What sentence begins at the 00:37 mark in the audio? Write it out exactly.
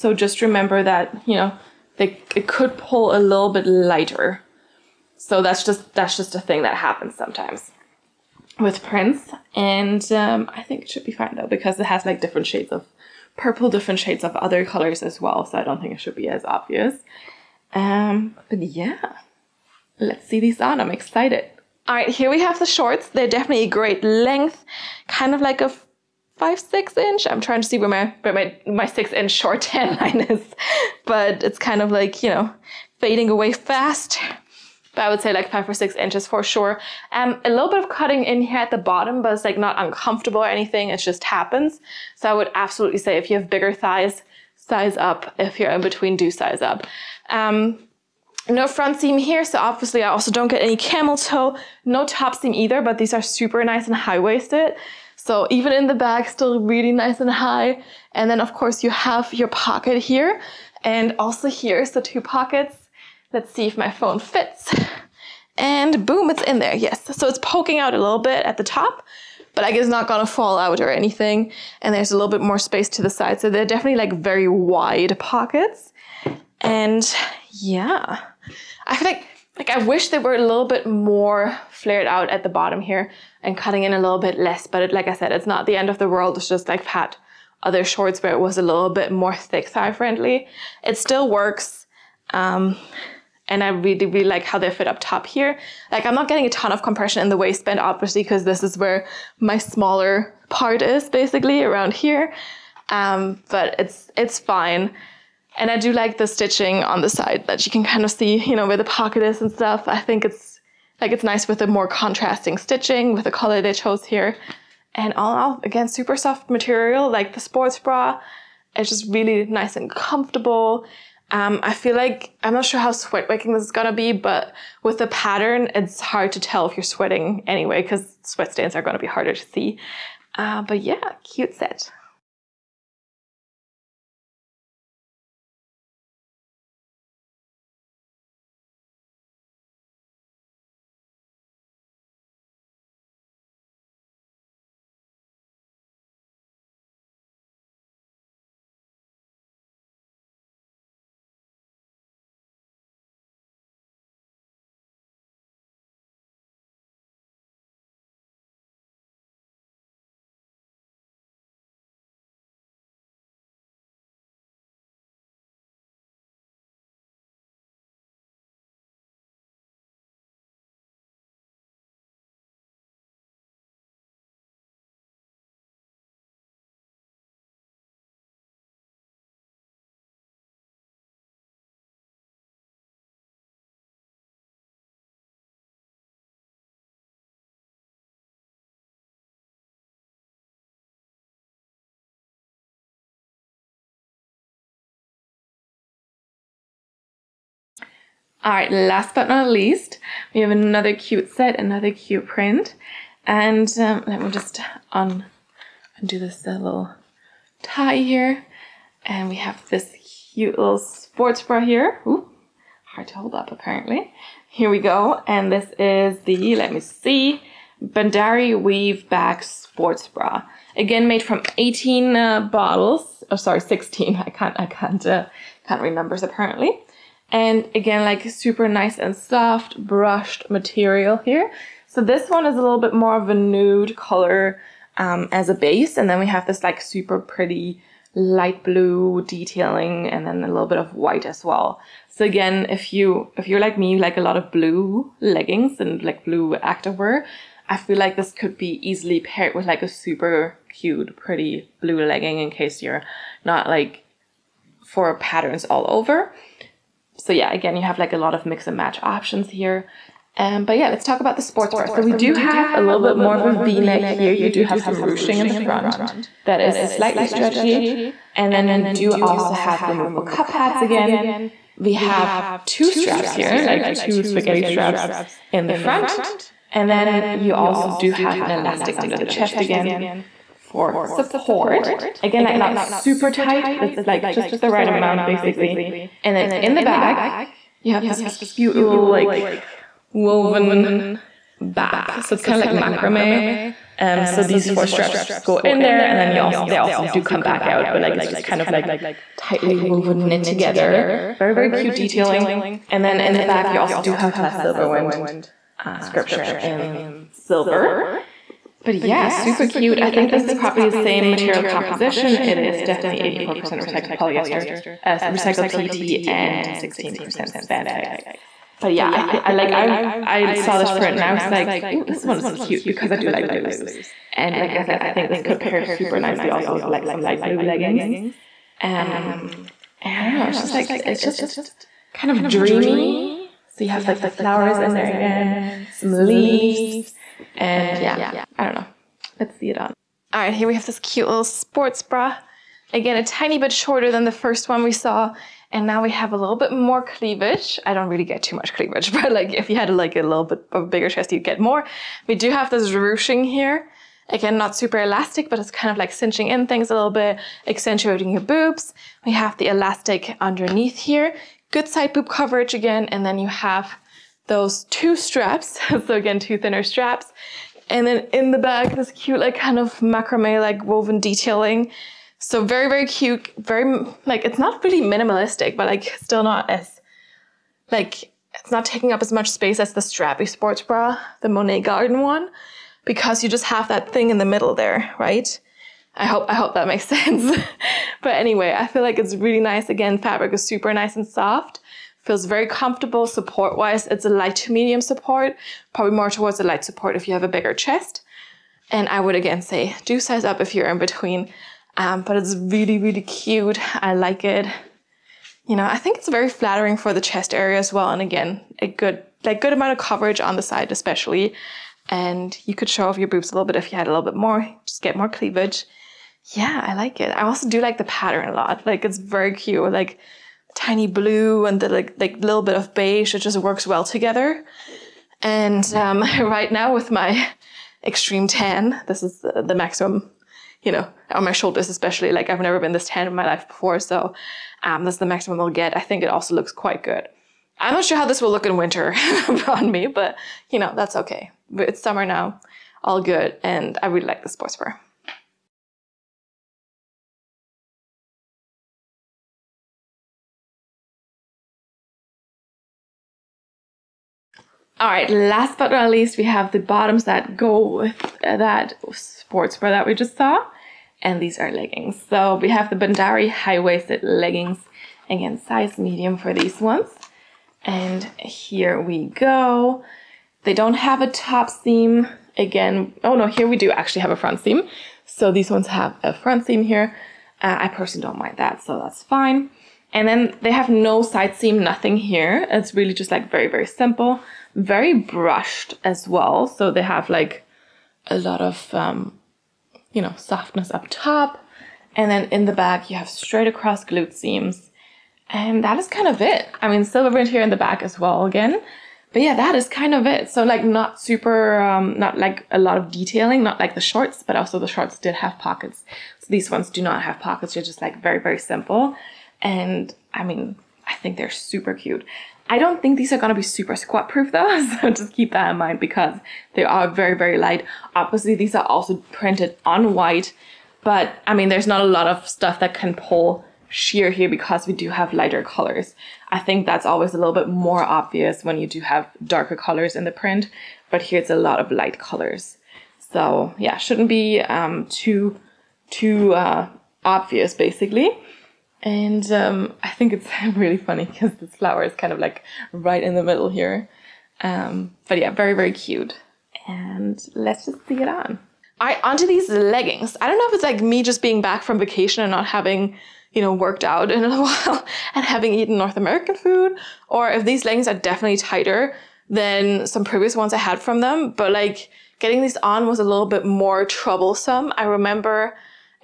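Um, a little bit of cutting in here at the bottom, but it's like not uncomfortable or anything.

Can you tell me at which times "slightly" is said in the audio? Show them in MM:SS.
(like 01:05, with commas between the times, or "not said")
04:26.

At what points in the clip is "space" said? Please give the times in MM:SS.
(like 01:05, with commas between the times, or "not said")
01:12, 06:19.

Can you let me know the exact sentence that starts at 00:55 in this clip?
So even in the back, still really nice and high.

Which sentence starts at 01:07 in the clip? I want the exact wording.
So it's poking out a little bit at the top, but I guess not gonna fall out or anything.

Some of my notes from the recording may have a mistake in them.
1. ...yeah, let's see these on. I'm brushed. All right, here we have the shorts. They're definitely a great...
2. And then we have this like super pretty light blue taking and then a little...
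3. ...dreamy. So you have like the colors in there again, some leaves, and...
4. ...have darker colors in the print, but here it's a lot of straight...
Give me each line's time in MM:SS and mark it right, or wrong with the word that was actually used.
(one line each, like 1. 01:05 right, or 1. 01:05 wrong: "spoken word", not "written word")
1. 00:18 wrong: "excited", not "brushed"
2. 03:55 wrong: "detailing", not "taking"
3. 05:32 wrong: "flowers", not "colors"
4. 08:49 wrong: "light", not "straight".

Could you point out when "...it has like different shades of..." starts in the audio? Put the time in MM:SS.
00:11.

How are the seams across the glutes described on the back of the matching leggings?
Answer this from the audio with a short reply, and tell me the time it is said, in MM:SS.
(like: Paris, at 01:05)
Straight across, at 08:13.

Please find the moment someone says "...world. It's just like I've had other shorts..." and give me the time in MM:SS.
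01:26.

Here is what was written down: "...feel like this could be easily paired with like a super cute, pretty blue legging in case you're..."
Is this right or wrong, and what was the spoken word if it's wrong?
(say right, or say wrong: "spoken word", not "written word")
right.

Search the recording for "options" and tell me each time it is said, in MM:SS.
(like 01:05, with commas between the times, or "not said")
04:19.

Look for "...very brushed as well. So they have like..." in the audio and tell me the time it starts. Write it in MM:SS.
08:04.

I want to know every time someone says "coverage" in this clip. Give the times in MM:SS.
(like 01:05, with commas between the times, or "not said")
06:02, 06:49.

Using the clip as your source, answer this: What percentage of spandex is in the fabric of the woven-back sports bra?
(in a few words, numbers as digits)
16%.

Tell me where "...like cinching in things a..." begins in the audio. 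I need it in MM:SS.
05:55.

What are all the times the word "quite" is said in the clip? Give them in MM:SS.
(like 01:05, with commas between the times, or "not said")
07:16.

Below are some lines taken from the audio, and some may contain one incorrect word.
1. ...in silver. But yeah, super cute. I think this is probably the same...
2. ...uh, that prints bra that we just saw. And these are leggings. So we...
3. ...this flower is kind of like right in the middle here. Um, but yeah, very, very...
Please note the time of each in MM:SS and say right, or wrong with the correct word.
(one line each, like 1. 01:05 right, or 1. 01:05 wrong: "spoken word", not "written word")
1. 05:06 right
2. 07:38 wrong: "sports", not "prints"
3. 09:01 right.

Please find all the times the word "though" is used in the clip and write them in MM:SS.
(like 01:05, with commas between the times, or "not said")
00:11, 08:34.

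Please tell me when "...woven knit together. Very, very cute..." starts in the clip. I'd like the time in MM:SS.
04:59.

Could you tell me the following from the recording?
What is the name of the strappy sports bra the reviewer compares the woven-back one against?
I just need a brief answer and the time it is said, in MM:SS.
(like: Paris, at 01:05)
Monet Garden, at 06:21.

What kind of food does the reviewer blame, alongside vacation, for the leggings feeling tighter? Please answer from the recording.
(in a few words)
North American food.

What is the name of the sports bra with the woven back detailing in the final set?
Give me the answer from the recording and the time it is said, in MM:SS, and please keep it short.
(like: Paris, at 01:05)
Bandari Weave Back Sports Bra, at 03:37.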